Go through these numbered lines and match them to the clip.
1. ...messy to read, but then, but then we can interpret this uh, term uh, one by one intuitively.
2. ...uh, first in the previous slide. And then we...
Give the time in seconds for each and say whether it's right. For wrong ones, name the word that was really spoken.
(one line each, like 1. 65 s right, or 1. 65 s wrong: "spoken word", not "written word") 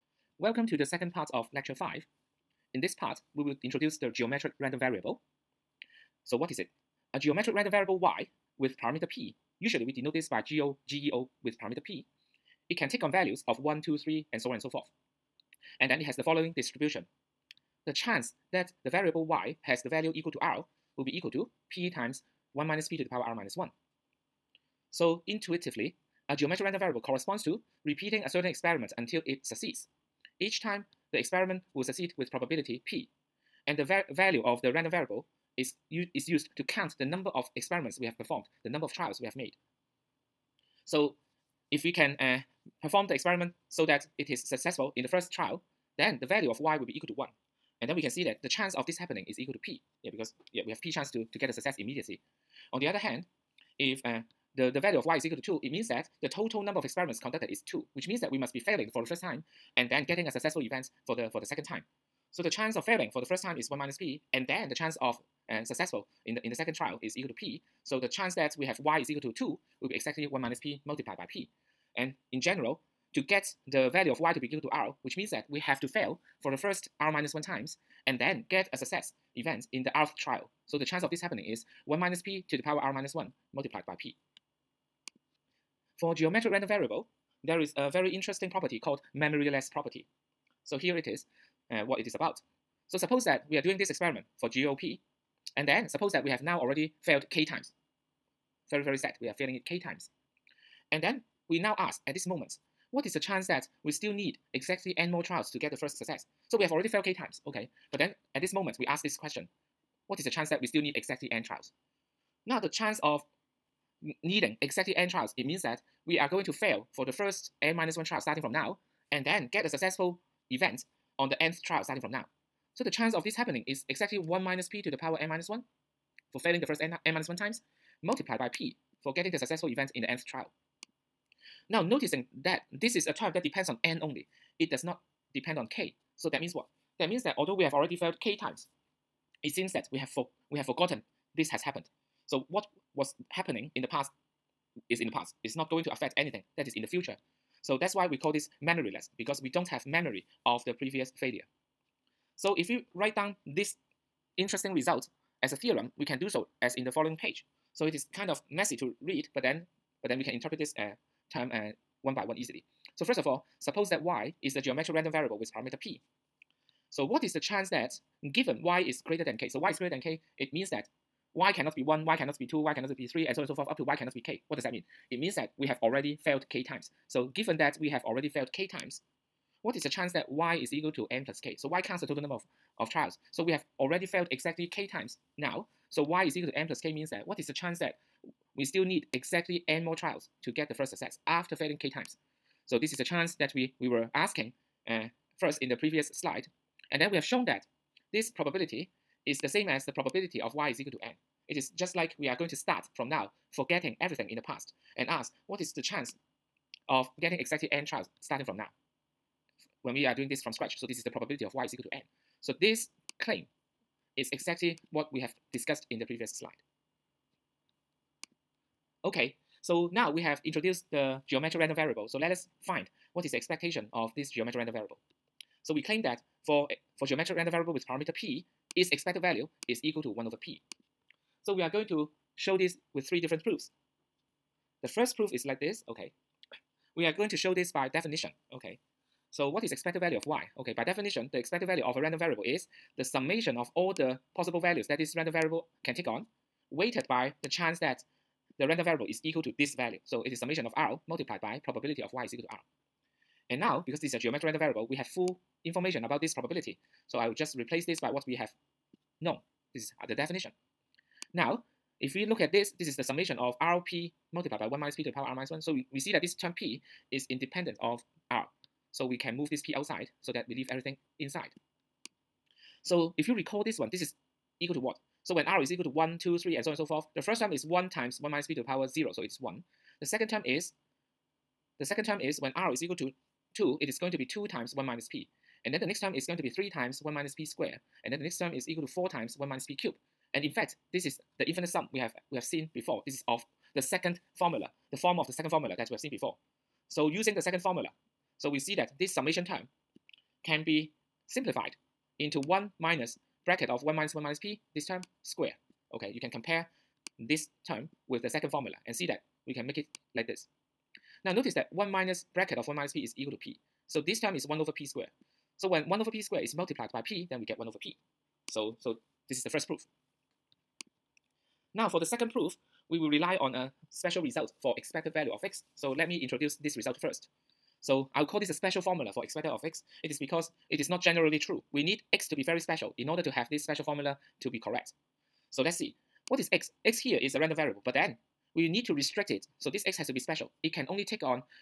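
1. 158 s wrong: "easily", not "intuitively"
2. 194 s right.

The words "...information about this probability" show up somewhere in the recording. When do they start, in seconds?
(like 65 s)
255 s.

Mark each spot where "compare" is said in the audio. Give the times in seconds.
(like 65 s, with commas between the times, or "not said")
306 s.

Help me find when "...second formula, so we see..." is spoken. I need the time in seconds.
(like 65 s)
297 s.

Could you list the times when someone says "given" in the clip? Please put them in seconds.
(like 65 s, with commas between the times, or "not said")
168 s, 177 s.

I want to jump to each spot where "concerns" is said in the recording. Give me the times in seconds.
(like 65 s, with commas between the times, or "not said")
not said.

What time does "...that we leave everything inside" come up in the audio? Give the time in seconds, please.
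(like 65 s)
270 s.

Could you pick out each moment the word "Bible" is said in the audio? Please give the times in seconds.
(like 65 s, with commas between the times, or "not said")
not said.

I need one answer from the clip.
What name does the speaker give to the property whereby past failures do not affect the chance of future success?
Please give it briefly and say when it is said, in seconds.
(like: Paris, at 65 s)
memoryless property, at 89 s.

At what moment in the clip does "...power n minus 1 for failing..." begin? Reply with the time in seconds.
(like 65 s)
124 s.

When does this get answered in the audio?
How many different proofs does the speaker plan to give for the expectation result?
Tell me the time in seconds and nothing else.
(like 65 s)
233 s.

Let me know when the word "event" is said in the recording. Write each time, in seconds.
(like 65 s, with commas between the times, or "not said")
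60 s, 79 s, 120 s, 129 s.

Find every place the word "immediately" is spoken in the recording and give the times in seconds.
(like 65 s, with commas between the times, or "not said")
51 s.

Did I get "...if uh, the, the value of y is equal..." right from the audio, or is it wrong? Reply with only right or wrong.
right.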